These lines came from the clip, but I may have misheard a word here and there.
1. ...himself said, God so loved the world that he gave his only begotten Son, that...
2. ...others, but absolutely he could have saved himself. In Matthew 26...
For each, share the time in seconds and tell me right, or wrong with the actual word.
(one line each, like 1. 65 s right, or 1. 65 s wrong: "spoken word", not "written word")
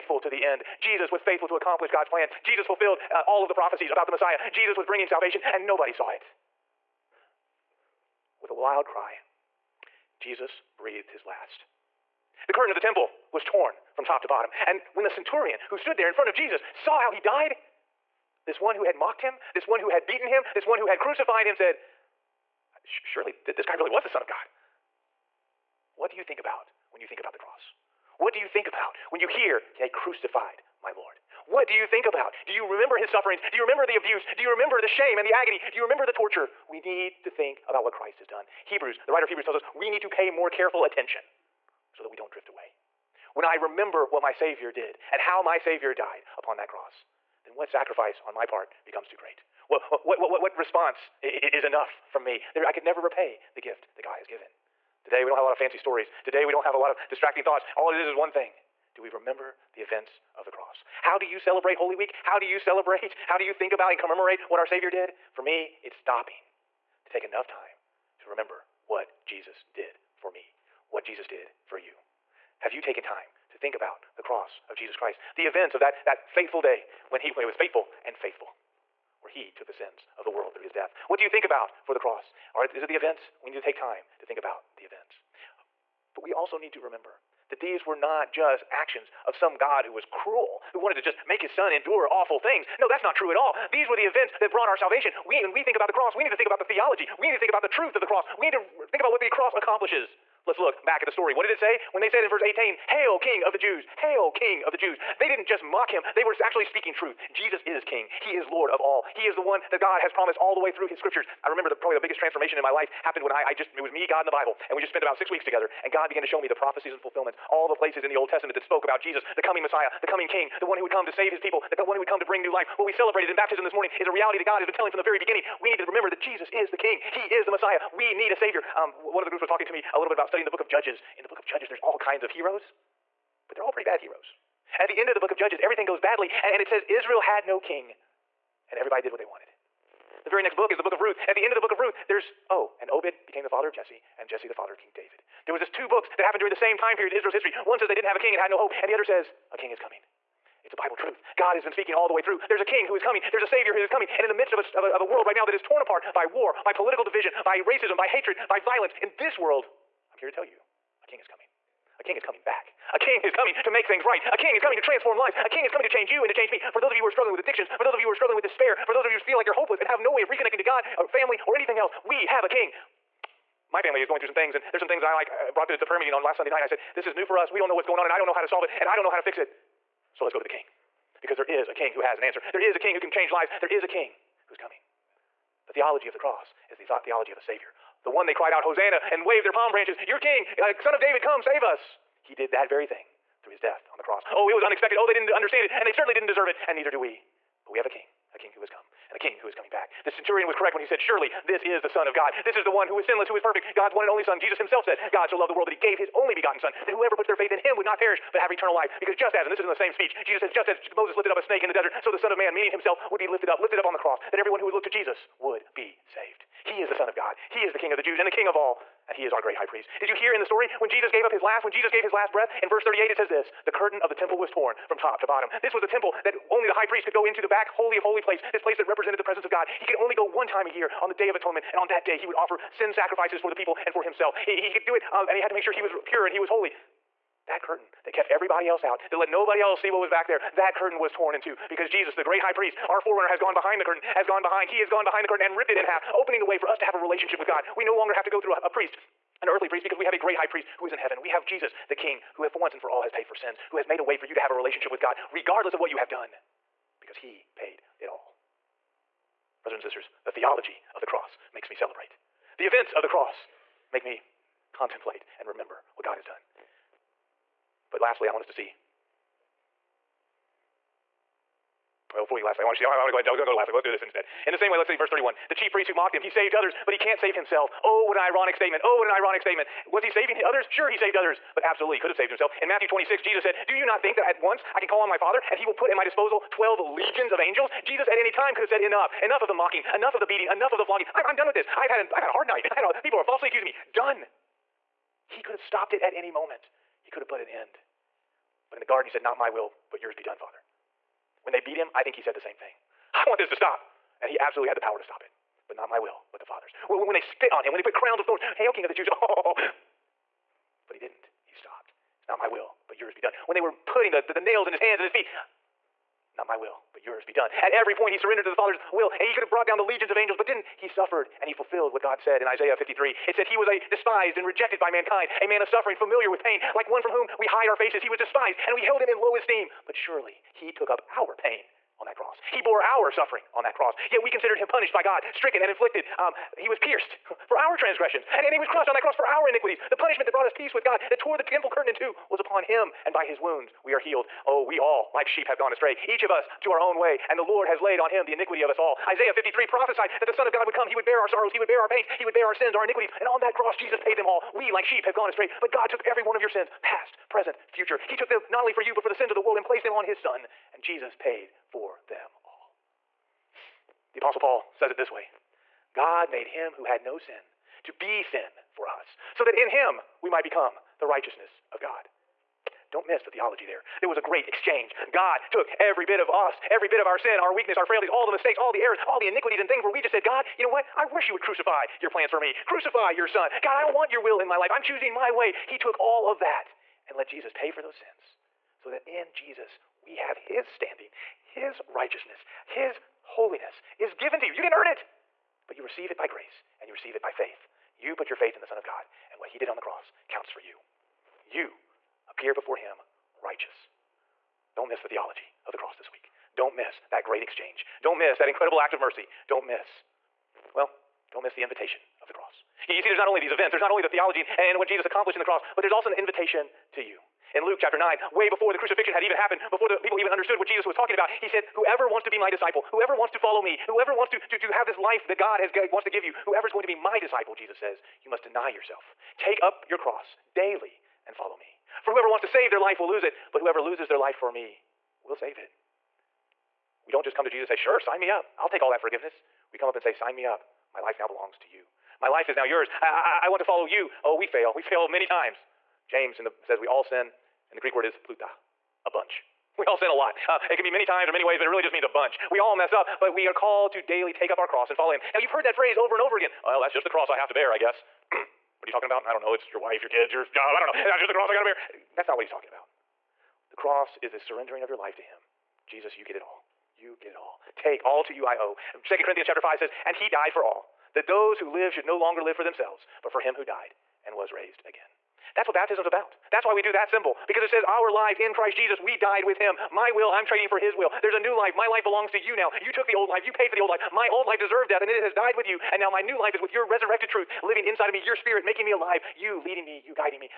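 1. 204 s right
2. 281 s right.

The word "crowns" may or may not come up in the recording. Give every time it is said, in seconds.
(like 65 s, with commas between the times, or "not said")
307 s.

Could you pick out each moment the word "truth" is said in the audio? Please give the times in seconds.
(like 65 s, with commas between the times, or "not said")
97 s, 106 s, 150 s, 487 s.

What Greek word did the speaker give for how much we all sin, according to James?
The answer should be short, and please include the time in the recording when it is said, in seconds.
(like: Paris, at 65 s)
pluta, at 448 s.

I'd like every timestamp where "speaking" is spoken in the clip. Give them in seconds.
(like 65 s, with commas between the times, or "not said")
106 s, 151 s.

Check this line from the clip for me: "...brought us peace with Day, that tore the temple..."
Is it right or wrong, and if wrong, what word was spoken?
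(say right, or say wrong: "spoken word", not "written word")
wrong: "God", not "Day".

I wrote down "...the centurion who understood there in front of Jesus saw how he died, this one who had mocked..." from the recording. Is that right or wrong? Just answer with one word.
wrong.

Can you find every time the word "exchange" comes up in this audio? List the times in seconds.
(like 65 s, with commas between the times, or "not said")
374 s, 407 s.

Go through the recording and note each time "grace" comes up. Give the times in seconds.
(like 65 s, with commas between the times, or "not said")
396 s.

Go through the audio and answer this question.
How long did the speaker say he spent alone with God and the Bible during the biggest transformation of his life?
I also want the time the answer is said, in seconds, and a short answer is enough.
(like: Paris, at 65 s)
about 6 weeks, at 115 s.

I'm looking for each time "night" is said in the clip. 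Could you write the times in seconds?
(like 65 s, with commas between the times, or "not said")
176 s, 292 s.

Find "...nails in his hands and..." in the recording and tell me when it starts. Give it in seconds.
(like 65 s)
314 s.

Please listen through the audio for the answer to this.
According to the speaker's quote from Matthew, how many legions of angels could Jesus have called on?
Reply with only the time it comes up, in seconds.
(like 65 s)
286 s.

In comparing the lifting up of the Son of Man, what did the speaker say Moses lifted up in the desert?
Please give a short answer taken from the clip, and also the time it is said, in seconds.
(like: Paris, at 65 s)
a snake, at 211 s.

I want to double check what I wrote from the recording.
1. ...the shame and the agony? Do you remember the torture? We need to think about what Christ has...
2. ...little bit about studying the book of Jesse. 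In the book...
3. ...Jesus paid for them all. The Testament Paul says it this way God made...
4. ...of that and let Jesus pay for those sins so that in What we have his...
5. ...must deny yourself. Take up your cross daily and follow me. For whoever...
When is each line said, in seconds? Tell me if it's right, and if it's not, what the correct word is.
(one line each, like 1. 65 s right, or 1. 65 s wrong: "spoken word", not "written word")
1. 34 s right
2. 129 s wrong: "Judges", not "Jesse"
3. 360 s wrong: "Apostle", not "Testament"
4. 386 s wrong: "Jesus", not "What"
5. 428 s right.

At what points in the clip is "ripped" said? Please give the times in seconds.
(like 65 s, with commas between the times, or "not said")
245 s.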